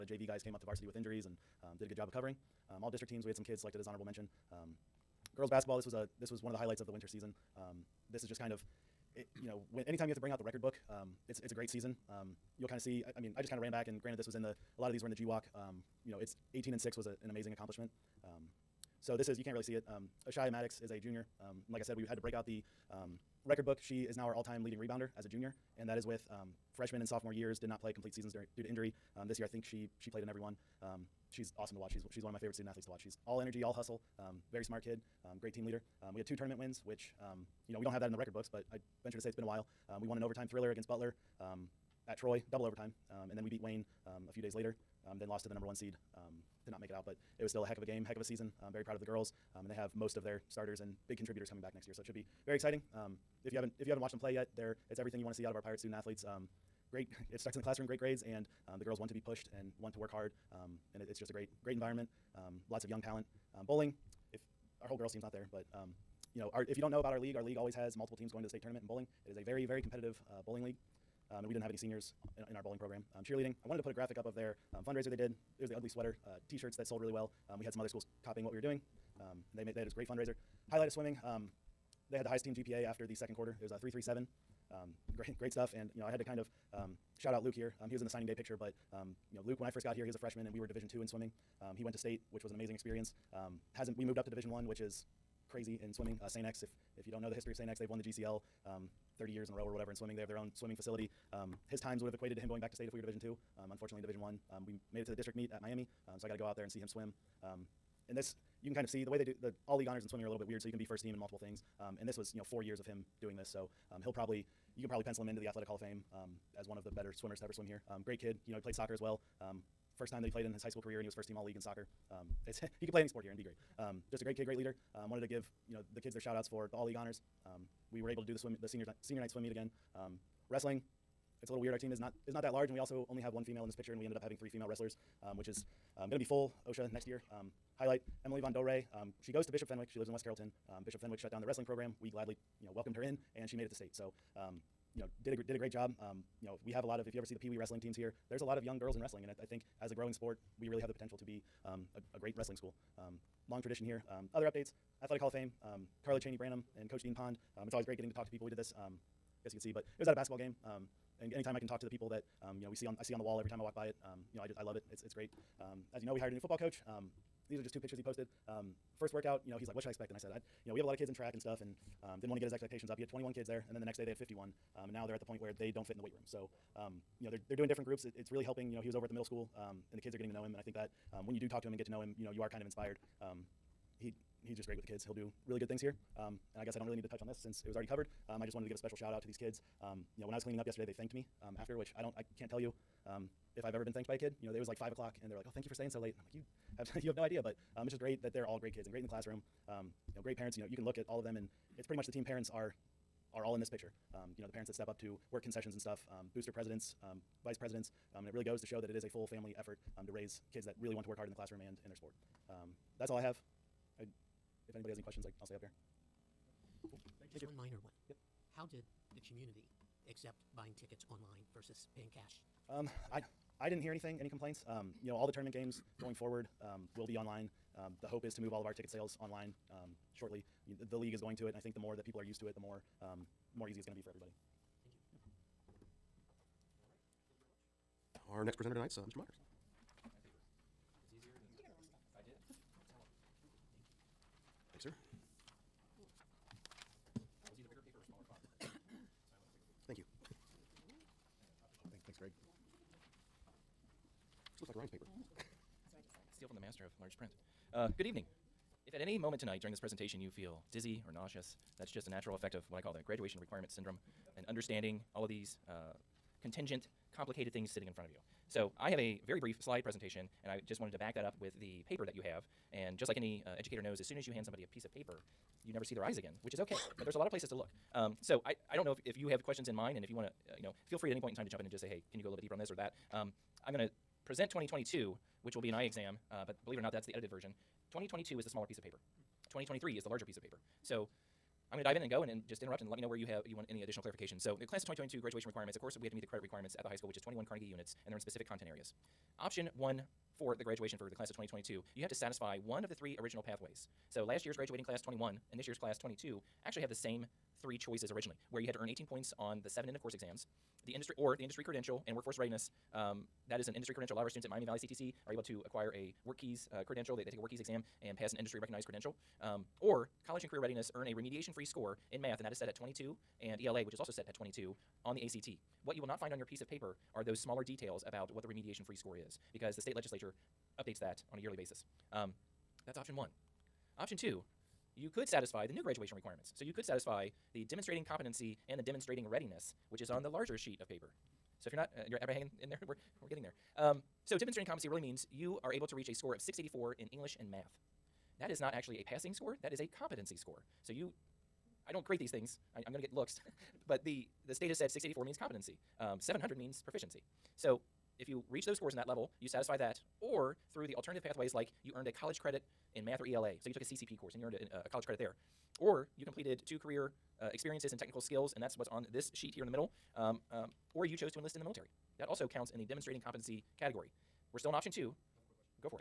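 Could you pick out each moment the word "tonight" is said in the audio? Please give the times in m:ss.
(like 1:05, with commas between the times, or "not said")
3:58, 4:19.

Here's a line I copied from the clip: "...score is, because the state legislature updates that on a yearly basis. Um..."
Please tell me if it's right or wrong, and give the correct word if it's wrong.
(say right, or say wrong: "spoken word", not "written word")
right.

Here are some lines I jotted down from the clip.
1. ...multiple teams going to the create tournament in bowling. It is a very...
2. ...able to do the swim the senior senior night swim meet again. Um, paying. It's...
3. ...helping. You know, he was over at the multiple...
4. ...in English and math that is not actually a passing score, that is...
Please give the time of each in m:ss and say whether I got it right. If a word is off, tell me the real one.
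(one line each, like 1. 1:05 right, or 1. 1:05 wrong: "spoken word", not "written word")
1. 1:07 wrong: "state", not "create"
2. 2:08 wrong: "wrestling", not "paying"
3. 2:58 wrong: "middle", not "multiple"
4. 5:46 right.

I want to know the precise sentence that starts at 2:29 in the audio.
And I, I think as a growing sport, we really have the potential to be um, a, a, great wrestling school.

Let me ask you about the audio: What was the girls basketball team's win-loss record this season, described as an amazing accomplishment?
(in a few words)
18 and 6.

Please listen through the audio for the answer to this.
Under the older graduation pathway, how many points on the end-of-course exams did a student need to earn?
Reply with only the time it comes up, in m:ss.
5:08.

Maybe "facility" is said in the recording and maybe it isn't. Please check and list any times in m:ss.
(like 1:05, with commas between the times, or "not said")
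1:40.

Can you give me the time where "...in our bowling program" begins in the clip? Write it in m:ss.
1:12.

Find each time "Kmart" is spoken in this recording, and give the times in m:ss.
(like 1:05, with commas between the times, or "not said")
not said.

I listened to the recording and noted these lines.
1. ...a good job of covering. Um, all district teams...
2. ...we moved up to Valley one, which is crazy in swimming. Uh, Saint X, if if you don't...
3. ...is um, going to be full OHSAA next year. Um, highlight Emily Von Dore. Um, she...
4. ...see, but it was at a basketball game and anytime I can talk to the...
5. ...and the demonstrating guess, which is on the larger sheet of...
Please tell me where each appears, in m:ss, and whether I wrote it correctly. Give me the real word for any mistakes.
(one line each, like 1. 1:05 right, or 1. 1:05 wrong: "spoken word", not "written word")
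1. 0:01 right
2. 1:33 wrong: "Division", not "Valley"
3. 2:15 right
4. 2:39 right
5. 5:38 wrong: "readiness", not "guess".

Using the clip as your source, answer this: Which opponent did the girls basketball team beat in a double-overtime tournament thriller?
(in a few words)
Butler.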